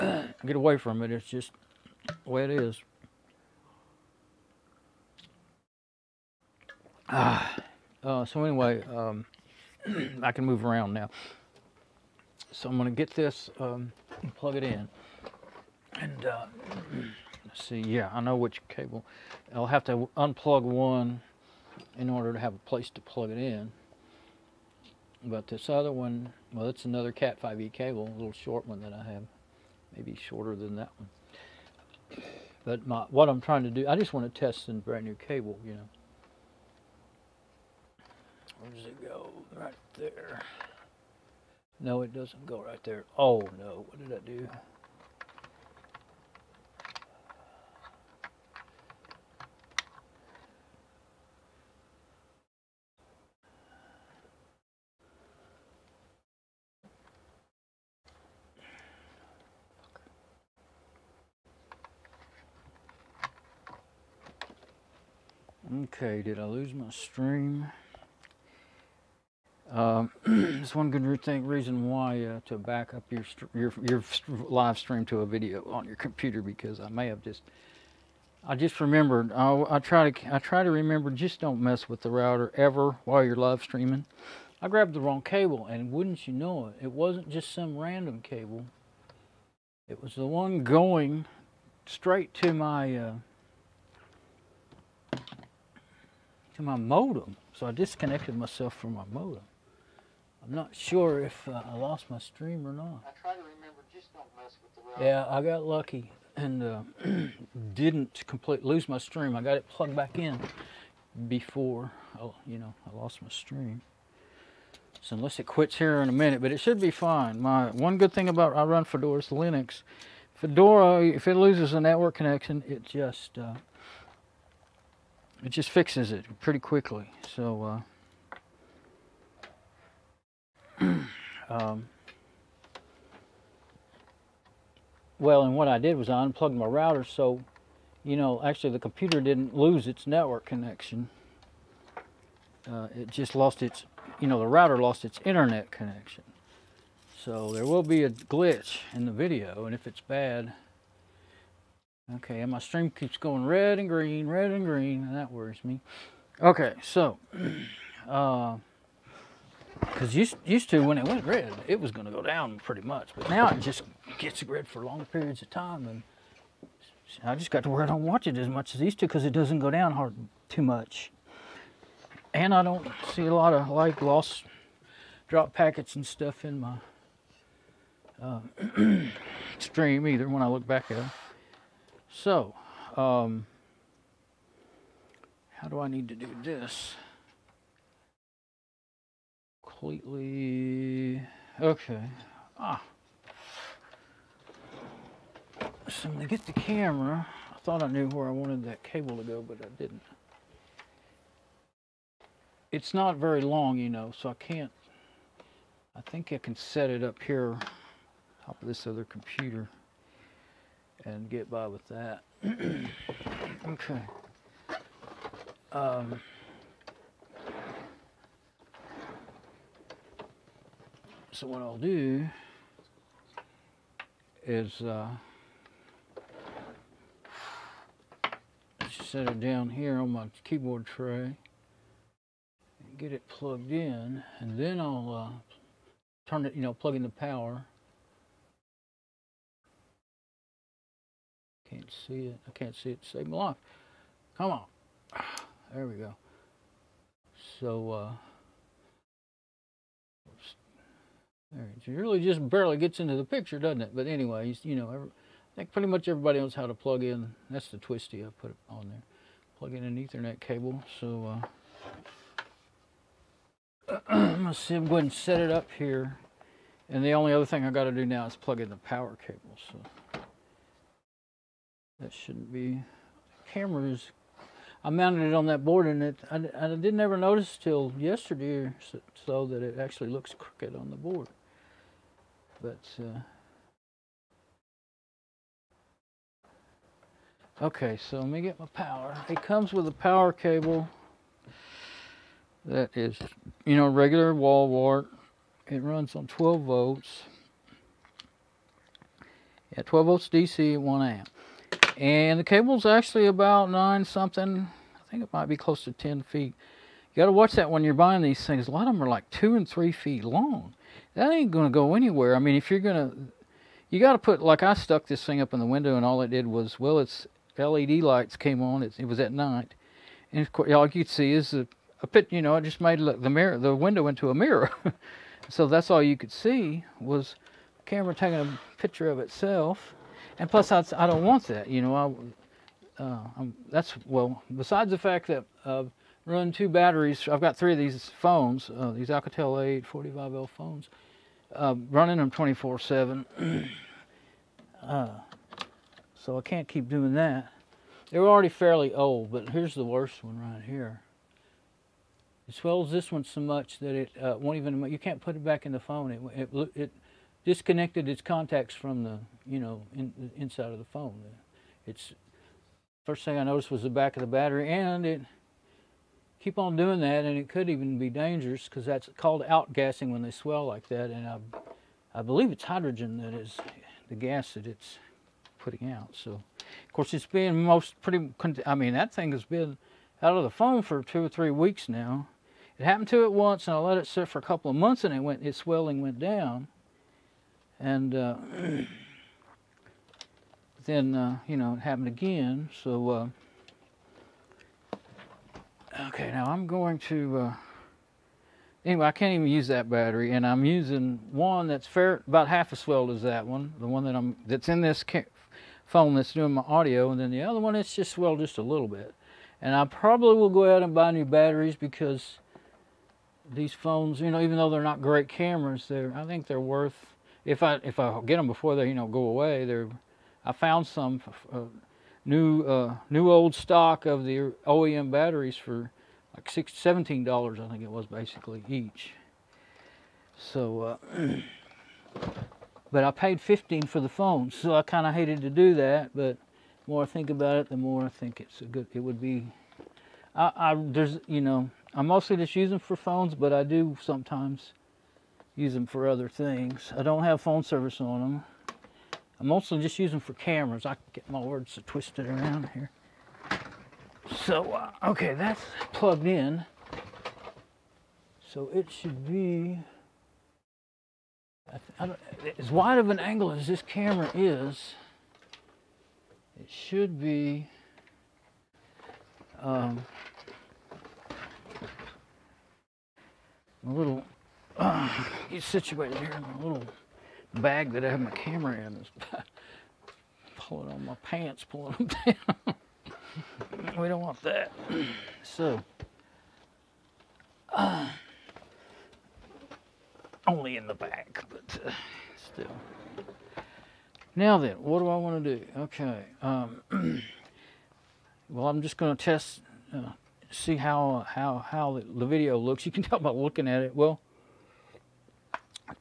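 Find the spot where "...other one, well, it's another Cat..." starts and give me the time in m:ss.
0:25.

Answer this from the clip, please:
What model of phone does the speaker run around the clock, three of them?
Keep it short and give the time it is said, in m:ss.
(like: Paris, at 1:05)
Alcatel A845L, at 5:39.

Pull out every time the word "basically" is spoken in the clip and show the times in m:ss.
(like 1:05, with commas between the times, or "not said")
7:08.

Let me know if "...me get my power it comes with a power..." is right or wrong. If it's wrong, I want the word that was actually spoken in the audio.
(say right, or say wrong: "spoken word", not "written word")
right.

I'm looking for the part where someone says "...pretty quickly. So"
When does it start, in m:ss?
2:06.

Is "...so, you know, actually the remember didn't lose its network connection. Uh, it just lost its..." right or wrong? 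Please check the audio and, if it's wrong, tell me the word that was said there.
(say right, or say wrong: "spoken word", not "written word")
wrong: "computer", not "remember".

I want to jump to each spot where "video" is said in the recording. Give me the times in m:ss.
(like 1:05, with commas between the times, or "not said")
1:15, 2:29, 8:22.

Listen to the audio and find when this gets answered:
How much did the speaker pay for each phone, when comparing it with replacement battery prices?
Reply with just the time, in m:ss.
7:13.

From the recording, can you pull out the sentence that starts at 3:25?
I think I can set it up here, top of this other computer, and get by with that.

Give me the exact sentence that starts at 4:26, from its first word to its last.
And the only other thing I got to do now is plug in the power cable.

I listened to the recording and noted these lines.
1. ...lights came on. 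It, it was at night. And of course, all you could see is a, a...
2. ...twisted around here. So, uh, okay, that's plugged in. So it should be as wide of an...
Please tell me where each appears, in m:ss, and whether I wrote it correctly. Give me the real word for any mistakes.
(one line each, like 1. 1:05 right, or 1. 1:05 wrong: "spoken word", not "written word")
1. 5:18 right
2. 7:31 right.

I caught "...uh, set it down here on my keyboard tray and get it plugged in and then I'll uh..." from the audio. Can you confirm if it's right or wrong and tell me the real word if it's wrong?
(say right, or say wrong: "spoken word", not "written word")
right.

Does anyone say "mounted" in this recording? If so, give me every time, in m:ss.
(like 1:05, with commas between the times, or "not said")
4:34.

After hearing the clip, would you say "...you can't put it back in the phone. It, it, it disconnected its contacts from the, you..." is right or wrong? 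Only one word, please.
right.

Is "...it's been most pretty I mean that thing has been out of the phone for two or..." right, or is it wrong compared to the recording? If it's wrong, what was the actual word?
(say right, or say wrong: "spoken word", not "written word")
right.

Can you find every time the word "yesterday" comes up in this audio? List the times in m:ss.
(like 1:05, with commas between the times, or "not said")
4:37.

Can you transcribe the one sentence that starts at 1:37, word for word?
So I disconnected myself from my modem.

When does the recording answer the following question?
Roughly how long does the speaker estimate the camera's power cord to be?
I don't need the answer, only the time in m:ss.
5:05.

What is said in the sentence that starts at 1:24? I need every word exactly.
I grabbed the wrong cable and wouldn't you know it, it wasn't just some random cable.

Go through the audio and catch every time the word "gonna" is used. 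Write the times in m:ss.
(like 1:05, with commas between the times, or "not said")
0:12, 4:24.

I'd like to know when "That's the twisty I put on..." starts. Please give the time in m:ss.
4:17.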